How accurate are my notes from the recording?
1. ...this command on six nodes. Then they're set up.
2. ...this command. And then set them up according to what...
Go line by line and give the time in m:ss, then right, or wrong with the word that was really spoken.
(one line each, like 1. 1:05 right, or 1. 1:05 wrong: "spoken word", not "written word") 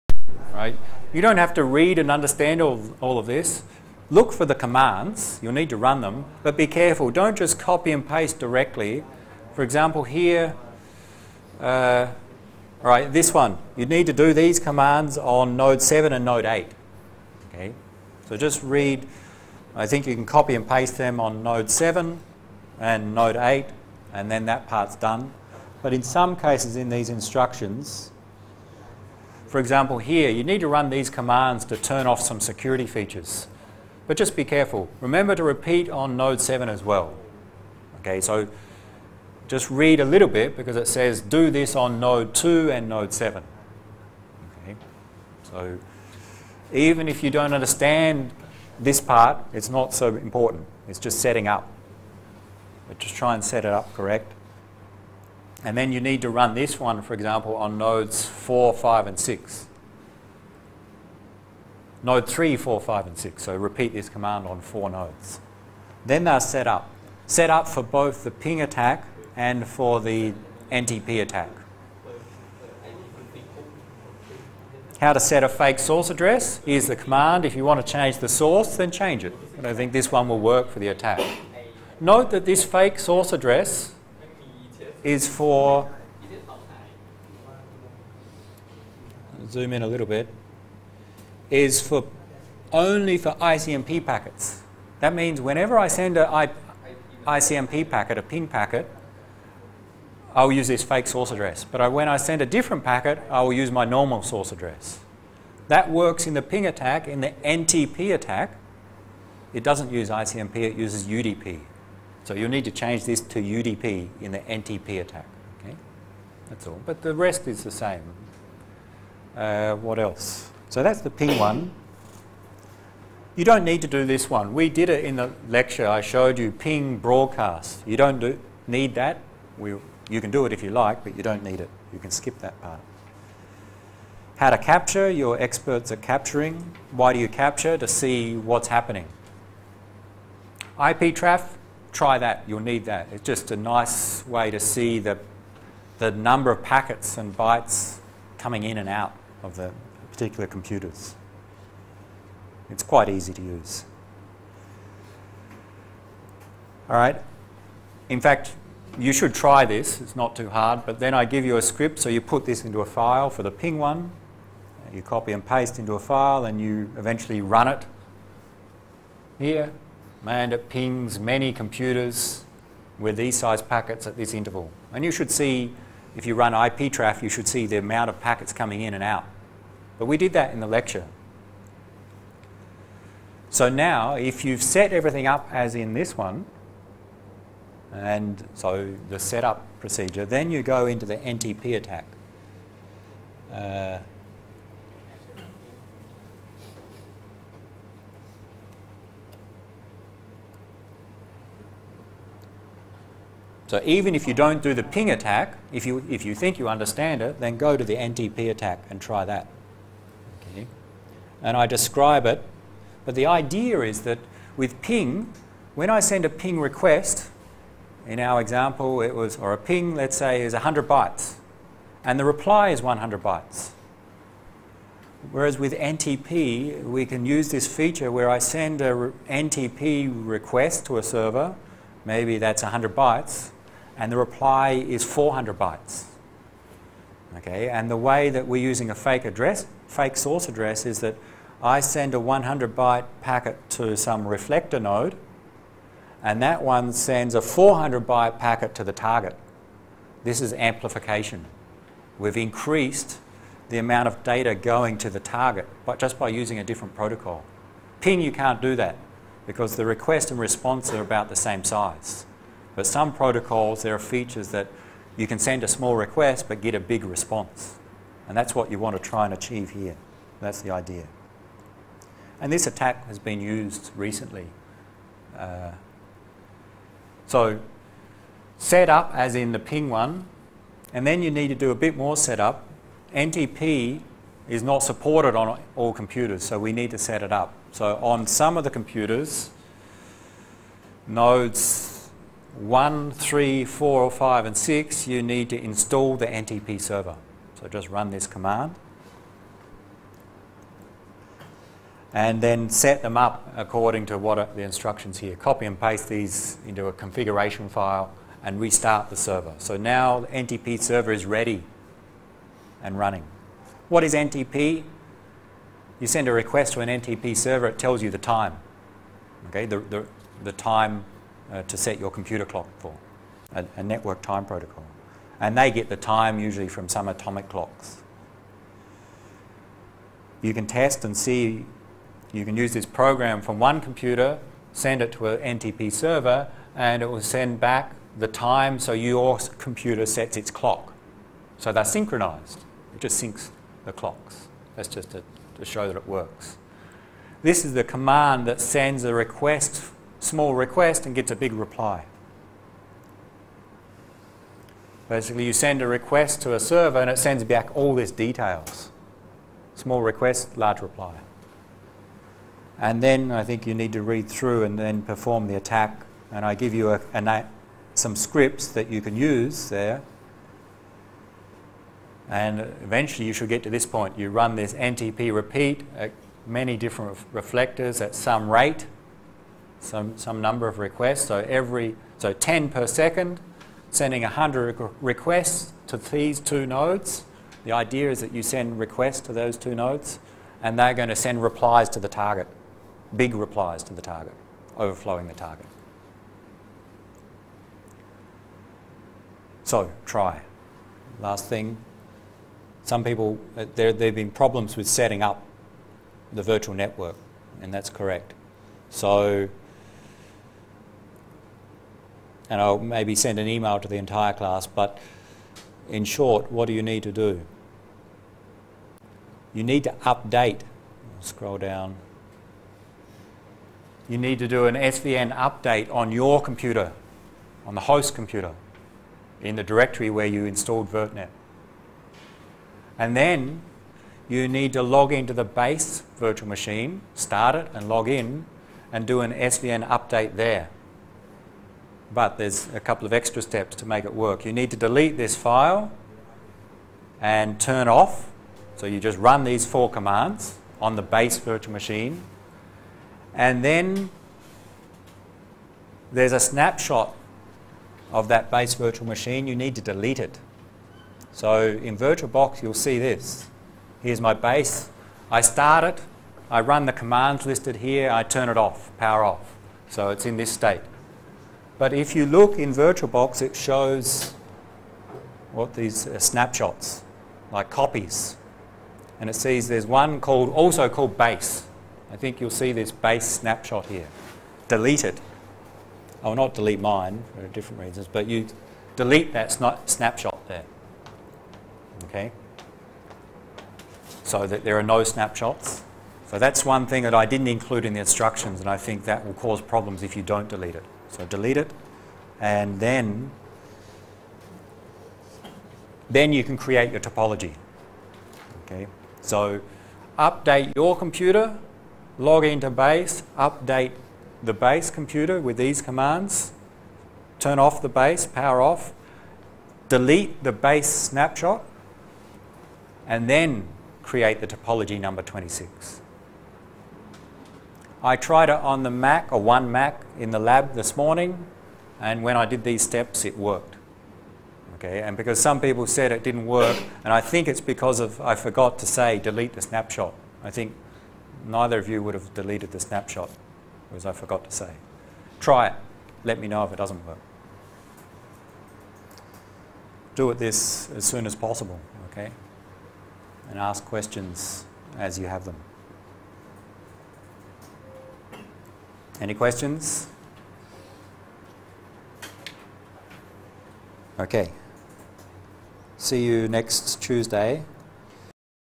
1. 1:03 wrong: "four", not "six"
2. 4:58 right.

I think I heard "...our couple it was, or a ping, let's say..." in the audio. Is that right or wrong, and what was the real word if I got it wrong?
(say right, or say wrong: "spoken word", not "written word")
wrong: "example", not "couple".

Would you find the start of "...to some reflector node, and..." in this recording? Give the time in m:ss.
4:03.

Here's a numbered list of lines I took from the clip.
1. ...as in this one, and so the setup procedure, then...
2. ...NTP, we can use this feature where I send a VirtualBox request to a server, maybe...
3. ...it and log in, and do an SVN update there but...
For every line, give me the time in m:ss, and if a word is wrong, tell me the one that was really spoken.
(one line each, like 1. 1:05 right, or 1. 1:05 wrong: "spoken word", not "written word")
1. 3:05 right
2. 3:45 wrong: "NTP", not "VirtualBox"
3. 7:17 right.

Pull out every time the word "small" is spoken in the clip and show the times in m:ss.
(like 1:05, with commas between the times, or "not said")
4:25, 5:50, 5:59.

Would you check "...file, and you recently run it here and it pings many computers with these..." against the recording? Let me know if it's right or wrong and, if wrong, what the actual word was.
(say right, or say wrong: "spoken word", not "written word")
wrong: "eventually", not "recently".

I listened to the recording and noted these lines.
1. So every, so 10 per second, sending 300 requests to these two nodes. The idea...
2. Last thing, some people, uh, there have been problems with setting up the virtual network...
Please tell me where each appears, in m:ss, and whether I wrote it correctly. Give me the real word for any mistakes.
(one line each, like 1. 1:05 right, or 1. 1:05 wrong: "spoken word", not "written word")
1. 6:21 wrong: "100", not "300"
2. 6:41 right.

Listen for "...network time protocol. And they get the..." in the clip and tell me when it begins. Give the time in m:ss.
5:23.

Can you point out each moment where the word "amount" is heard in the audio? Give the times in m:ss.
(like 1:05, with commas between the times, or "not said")
2:57, 4:13.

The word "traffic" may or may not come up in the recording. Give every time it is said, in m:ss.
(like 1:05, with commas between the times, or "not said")
2:21, 2:56.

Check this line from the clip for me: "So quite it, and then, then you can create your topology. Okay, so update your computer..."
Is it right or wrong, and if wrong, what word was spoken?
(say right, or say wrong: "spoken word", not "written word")
wrong: "delete", not "quite".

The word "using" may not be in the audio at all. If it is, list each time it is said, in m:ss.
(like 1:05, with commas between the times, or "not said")
3:58, 4:16.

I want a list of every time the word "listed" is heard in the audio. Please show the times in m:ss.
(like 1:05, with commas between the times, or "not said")
7:47.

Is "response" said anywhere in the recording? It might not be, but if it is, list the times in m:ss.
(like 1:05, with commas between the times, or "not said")
4:20, 4:27.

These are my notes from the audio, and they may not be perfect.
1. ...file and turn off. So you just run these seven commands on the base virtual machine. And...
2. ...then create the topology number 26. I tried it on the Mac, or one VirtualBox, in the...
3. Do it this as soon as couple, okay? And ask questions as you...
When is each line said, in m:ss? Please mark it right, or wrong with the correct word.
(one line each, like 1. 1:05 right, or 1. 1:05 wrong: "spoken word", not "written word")
1. 7:25 wrong: "four", not "seven"
2. 8:43 wrong: "Mac", not "VirtualBox"
3. 9:10 wrong: "possible", not "couple".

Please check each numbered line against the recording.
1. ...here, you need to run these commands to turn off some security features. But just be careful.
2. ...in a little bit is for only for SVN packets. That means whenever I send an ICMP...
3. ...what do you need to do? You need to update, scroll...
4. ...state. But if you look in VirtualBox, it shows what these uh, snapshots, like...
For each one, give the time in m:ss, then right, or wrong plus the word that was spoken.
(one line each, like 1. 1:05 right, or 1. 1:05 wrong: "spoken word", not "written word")
1. 0:29 right
2. 1:29 wrong: "ICMP", not "SVN"
3. 6:56 right
4. 7:50 right.